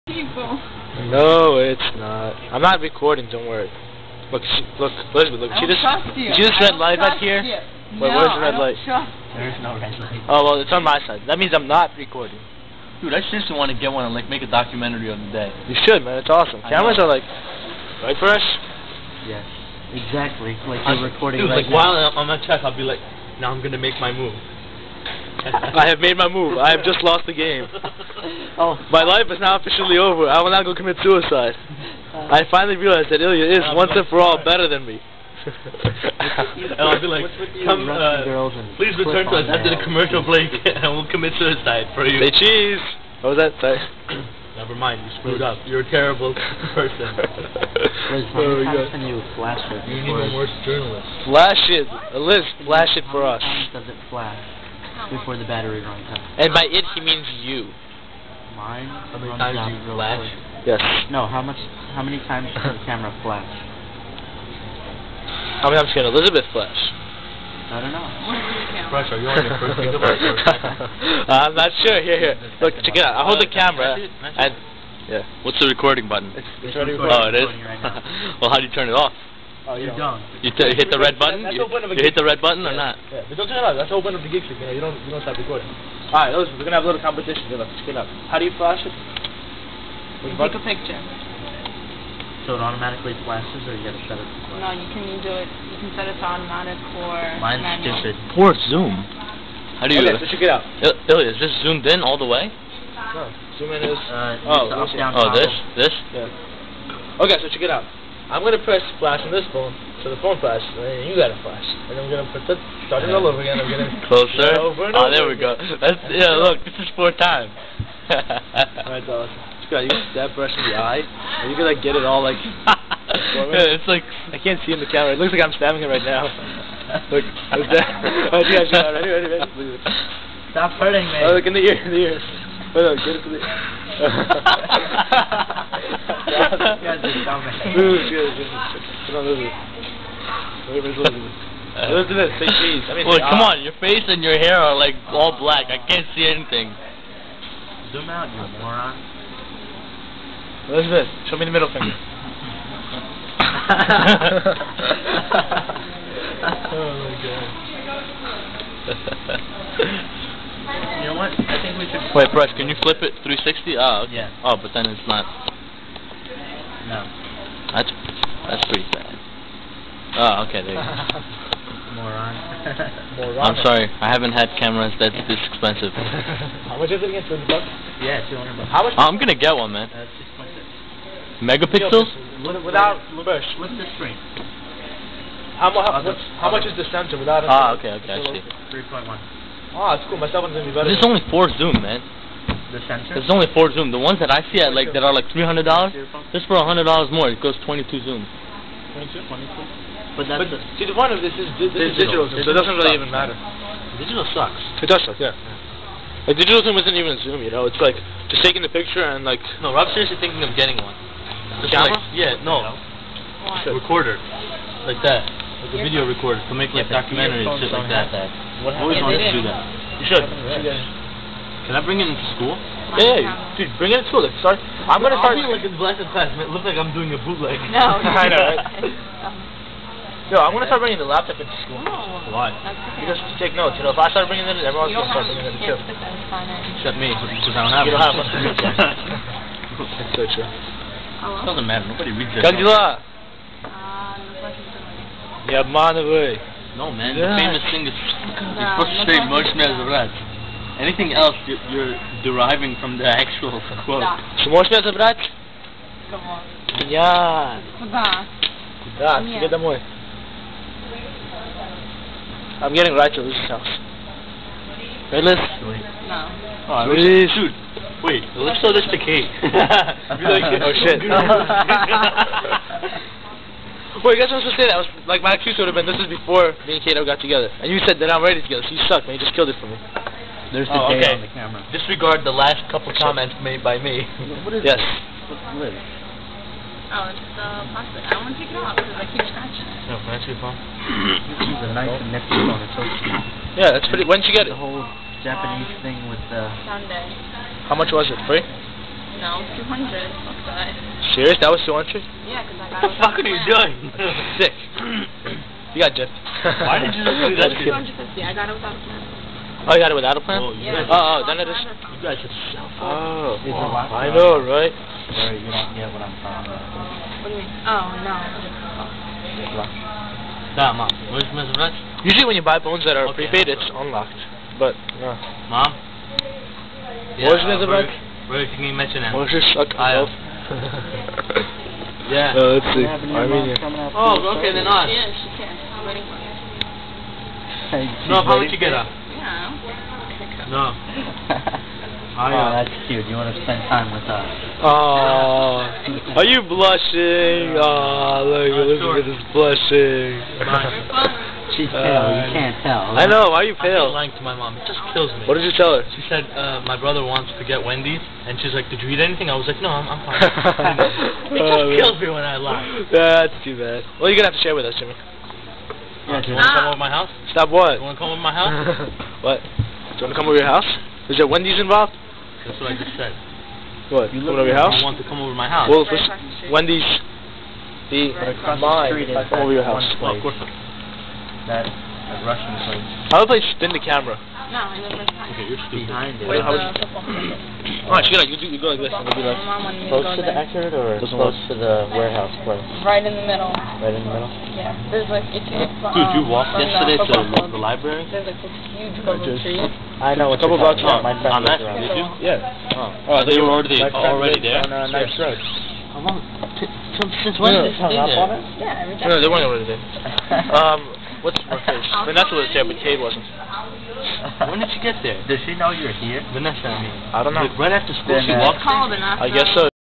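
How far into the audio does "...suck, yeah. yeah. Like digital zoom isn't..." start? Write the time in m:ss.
3:25.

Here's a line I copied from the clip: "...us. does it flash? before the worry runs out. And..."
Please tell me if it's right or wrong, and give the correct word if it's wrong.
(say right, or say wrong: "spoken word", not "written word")
wrong: "battery", not "worry".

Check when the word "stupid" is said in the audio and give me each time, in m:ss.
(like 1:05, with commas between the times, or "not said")
1:38, 6:25.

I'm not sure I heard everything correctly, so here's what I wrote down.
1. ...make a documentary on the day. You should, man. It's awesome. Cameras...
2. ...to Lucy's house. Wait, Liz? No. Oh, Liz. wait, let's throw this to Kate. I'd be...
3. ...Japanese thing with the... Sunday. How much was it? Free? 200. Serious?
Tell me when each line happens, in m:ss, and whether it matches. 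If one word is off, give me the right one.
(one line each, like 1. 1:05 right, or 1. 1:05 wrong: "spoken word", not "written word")
1. 0:14 right
2. 4:23 right
3. 4:55 right.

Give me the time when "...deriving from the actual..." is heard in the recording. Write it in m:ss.
4:12.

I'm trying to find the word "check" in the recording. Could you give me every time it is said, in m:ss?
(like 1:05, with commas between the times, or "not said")
0:22, 1:12, 1:40, 1:47.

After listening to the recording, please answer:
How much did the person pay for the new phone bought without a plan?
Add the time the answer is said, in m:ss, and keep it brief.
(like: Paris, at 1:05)
250, at 5:07.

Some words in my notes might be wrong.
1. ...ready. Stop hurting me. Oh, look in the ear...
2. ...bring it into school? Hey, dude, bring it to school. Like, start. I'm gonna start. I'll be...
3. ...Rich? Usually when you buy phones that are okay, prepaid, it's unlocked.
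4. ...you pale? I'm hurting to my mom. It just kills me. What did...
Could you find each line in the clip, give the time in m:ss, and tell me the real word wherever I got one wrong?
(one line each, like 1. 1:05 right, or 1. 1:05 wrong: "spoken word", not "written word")
1. 2:09 right
2. 3:41 right
3. 5:21 right
4. 5:53 wrong: "lying", not "hurting".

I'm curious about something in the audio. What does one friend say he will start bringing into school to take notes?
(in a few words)
the laptop.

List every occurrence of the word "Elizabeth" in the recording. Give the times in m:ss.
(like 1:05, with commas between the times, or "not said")
0:05, 1:06, 5:48.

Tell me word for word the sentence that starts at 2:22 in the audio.
I mean, Look, come on, your face and your hair are like all black.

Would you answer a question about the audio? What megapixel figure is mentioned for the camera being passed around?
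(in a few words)
6.6.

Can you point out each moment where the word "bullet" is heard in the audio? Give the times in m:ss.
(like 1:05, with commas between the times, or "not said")
not said.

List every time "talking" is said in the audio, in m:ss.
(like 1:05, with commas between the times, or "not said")
5:16, 6:40.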